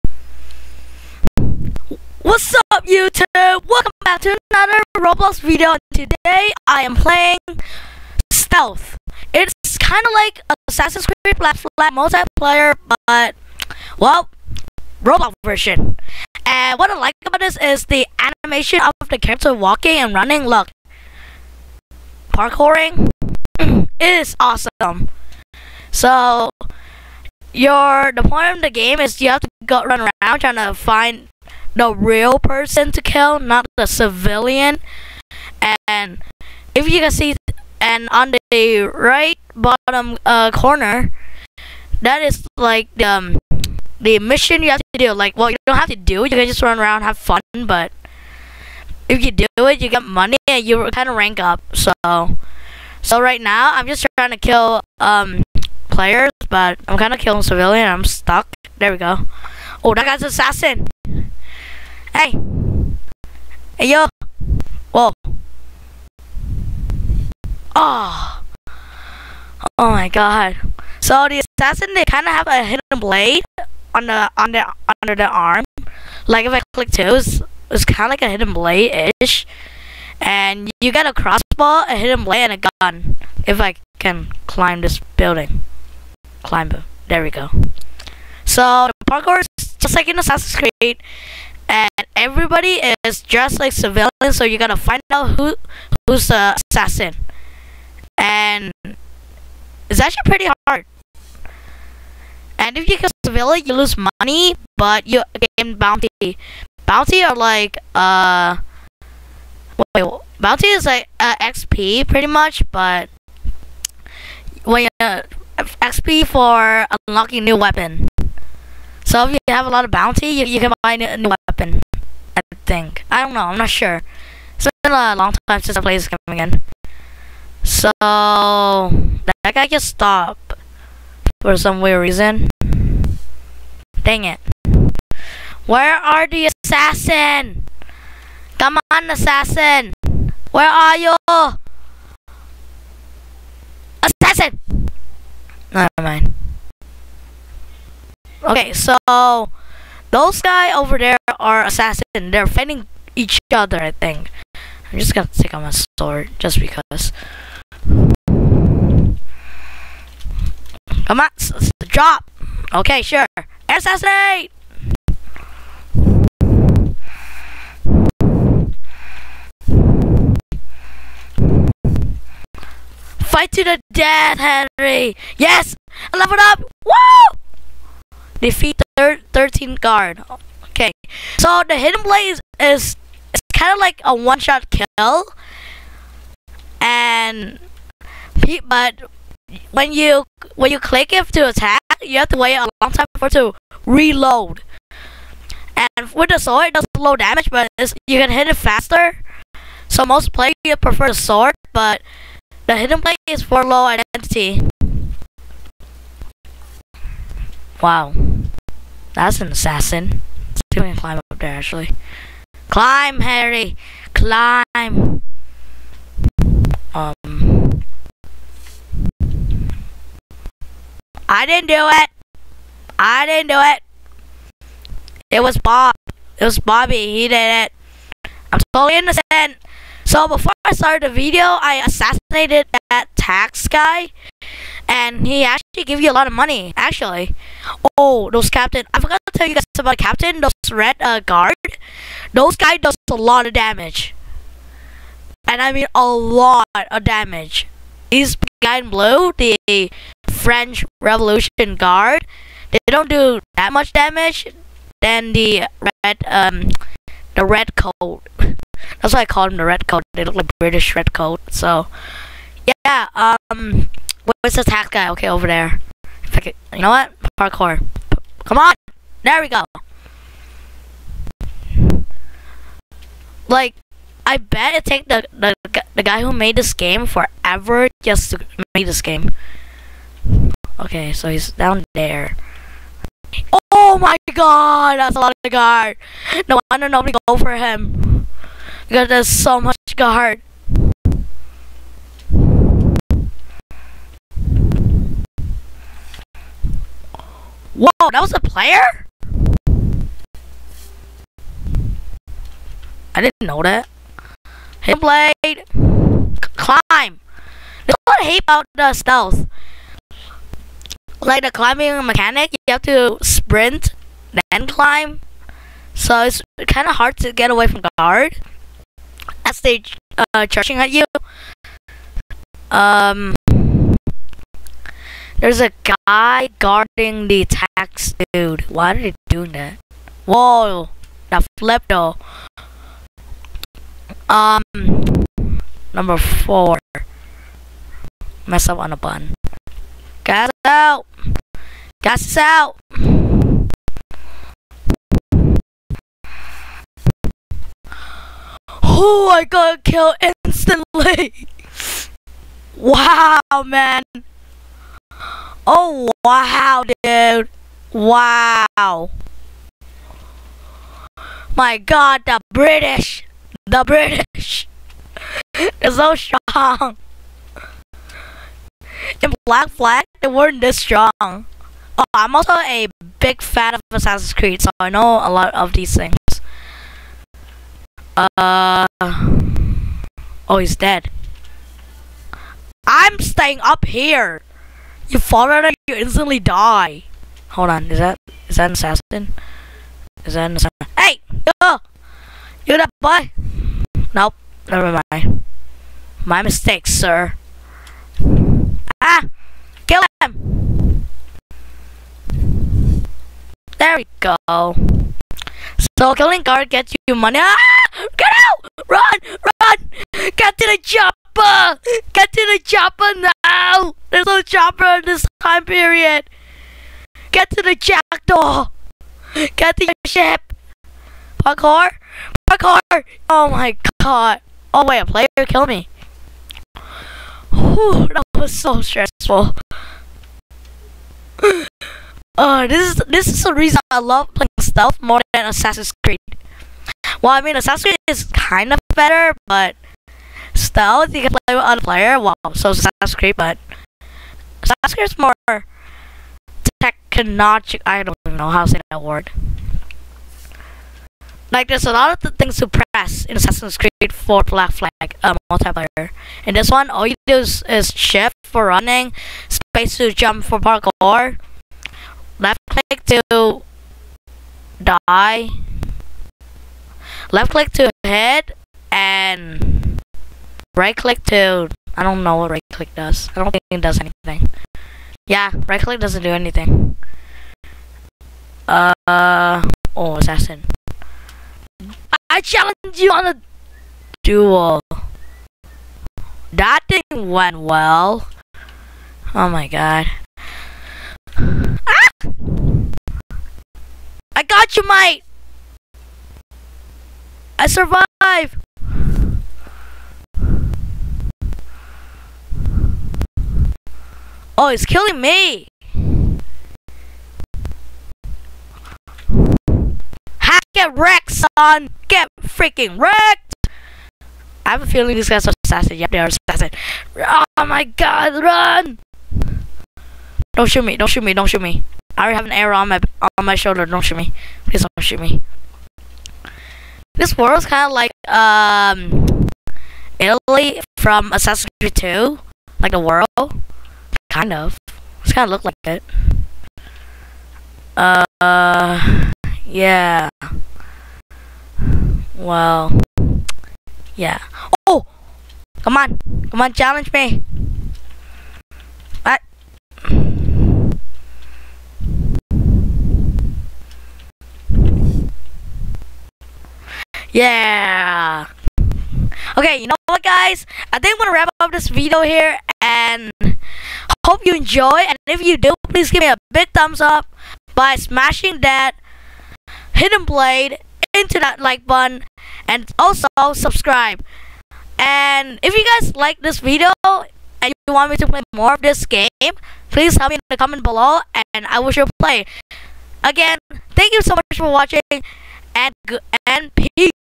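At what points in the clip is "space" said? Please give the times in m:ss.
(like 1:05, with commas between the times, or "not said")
7:39.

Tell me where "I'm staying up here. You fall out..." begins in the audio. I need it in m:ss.
6:22.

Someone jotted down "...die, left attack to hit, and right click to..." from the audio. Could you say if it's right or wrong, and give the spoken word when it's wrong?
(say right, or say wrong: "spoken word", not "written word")
wrong: "click", not "attack".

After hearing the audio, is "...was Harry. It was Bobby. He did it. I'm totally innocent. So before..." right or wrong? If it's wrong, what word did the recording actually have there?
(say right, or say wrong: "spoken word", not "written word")
wrong: "Bob", not "Harry".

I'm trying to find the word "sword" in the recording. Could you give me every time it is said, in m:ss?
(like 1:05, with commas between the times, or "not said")
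2:35, 3:16, 3:21.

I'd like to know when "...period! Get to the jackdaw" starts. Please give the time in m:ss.
6:55.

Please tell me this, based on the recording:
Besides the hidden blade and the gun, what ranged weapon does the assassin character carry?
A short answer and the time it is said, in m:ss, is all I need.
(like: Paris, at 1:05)
crossbow, at 1:21.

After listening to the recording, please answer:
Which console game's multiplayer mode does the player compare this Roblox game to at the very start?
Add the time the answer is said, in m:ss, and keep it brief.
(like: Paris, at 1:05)
Assassin's Creed Black Flag, at 0:10.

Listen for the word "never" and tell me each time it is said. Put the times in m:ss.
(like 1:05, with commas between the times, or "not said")
2:25, 6:34.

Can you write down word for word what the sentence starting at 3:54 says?
And he actually gave you a lot of money, actually.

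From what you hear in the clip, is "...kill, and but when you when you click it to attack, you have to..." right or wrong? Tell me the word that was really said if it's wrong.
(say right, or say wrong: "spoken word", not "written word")
right.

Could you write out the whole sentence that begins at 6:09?
In Black Flag, they weren't this strong.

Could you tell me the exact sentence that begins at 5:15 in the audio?
So it's kind of hard to get away from guard as they uh, charging at you.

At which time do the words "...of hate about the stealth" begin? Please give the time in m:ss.
5:08.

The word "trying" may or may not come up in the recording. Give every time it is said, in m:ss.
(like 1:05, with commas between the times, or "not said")
0:30, 0:54.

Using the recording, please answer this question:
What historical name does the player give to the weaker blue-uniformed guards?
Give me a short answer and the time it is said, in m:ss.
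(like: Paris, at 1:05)
French Revolution Guard, at 4:10.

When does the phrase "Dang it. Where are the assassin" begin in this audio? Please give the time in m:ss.
2:14.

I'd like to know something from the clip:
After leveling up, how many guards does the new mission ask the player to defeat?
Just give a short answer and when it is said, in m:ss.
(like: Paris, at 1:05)
13, at 2:59.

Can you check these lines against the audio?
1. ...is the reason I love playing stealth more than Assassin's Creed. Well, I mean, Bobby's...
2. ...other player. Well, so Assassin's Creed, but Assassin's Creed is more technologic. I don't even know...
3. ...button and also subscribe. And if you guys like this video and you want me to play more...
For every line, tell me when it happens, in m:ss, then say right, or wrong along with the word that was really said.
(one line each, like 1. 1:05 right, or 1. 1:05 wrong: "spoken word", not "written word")
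1. 7:13 wrong: "Assassin", not "Bobby"
2. 7:21 right
3. 9:31 right.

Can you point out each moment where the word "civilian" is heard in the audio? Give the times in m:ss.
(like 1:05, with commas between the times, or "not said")
0:33, 0:57, 1:33, 1:43.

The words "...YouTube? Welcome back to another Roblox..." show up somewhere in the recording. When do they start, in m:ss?
0:02.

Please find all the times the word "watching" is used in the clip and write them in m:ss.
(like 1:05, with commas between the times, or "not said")
9:44.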